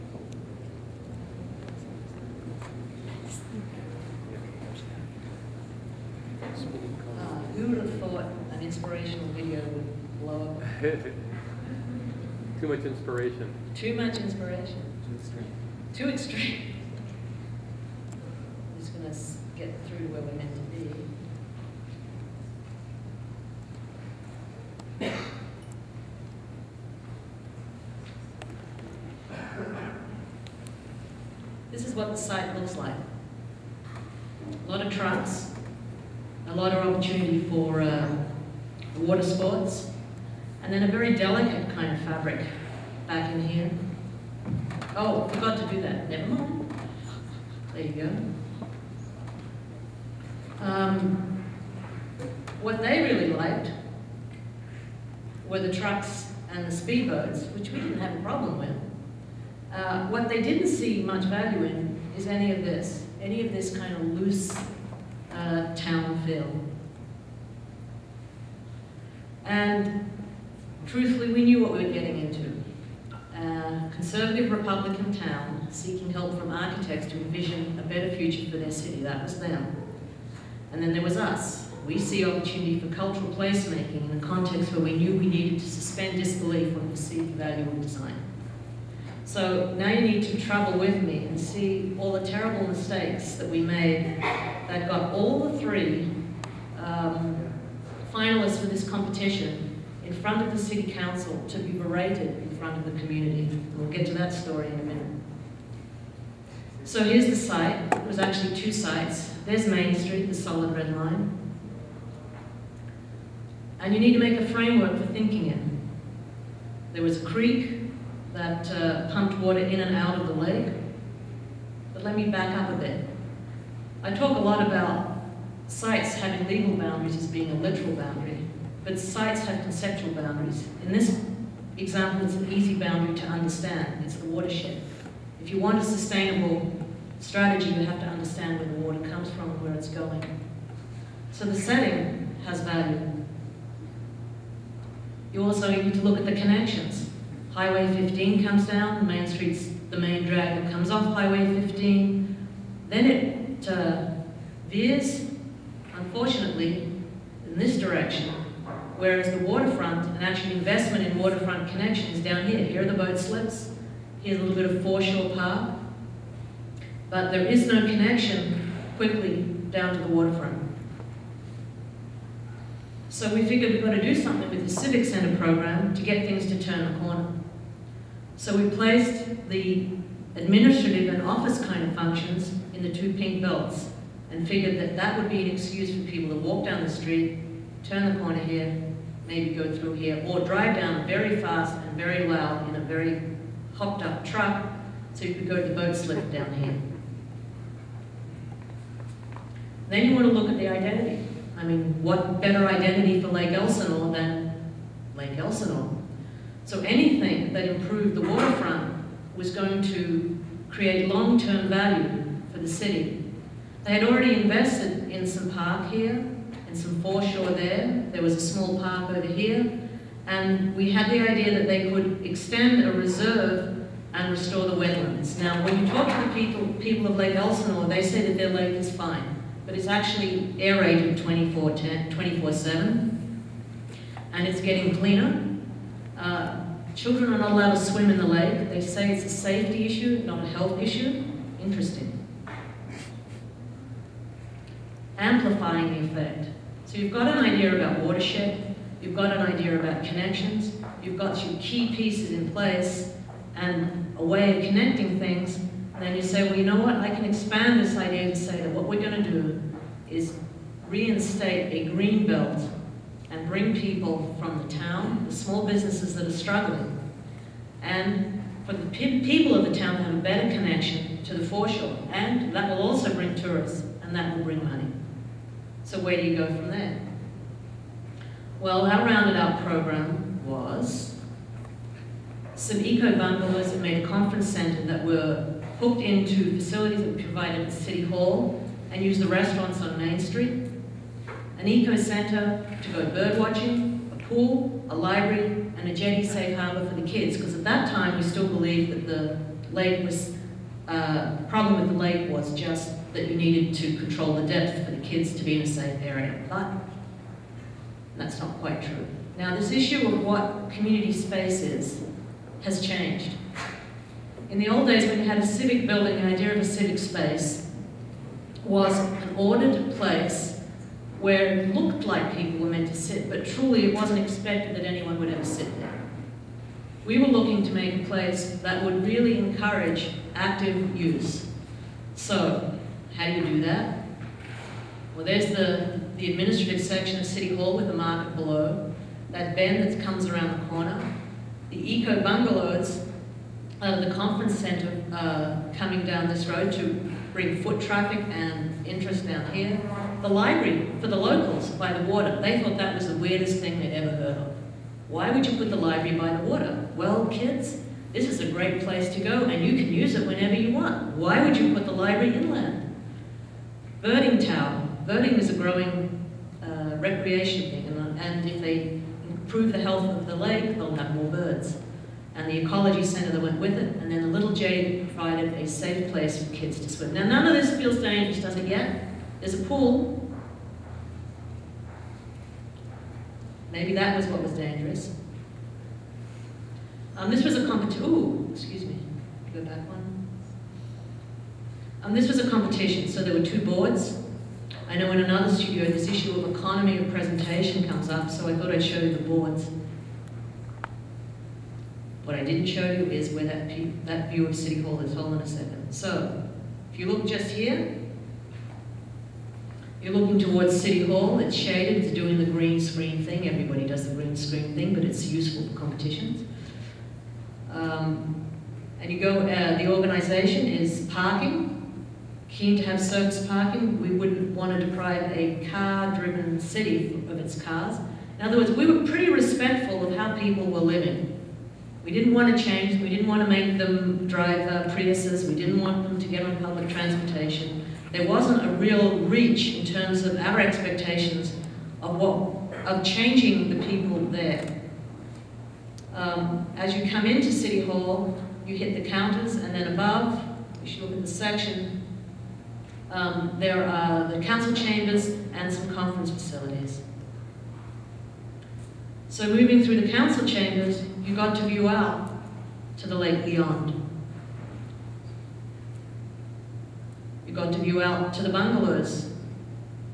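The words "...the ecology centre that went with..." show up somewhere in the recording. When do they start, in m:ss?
6:12.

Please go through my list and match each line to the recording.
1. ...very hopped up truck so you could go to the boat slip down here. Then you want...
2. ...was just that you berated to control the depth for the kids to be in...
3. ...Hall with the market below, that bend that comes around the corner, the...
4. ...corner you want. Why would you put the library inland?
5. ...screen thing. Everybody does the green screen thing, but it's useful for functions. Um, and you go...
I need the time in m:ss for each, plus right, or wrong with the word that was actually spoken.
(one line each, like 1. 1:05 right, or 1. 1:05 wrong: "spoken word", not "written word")
1. 3:12 right
2. 5:02 wrong: "needed", not "berated"
3. 5:37 right
4. 6:00 wrong: "whenever", not "corner"
5. 6:52 wrong: "competitions", not "functions".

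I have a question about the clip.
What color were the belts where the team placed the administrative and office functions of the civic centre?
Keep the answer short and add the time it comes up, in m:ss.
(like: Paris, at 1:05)
Pink, at 3:03.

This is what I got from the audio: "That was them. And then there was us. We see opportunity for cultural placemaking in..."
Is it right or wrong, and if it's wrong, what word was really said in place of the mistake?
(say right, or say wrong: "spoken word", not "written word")
right.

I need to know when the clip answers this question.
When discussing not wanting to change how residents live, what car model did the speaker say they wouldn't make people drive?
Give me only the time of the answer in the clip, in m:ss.
7:14.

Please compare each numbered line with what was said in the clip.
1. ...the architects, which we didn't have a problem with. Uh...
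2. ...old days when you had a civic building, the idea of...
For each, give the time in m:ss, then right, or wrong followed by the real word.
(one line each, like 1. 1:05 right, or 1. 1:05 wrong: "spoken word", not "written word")
1. 0:56 wrong: "speedboats", not "architects"
2. 5:14 right.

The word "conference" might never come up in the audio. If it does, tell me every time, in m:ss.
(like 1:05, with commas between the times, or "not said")
4:44, 5:44, 7:35.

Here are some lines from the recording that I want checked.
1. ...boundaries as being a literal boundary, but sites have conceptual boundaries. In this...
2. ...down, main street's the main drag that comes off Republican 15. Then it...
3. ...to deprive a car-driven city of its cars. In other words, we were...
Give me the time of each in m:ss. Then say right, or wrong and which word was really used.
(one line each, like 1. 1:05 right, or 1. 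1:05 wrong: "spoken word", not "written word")
1. 2:06 right
2. 2:28 wrong: "Highway", not "Republican"
3. 7:04 right.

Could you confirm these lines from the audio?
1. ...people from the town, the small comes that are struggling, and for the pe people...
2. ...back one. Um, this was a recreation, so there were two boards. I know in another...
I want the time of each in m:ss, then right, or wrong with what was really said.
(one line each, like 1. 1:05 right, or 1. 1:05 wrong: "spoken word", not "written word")
1. 4:23 wrong: "businesses", not "comes"
2. 6:29 wrong: "competition", not "recreation".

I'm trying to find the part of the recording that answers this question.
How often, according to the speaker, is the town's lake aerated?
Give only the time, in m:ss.
3:51.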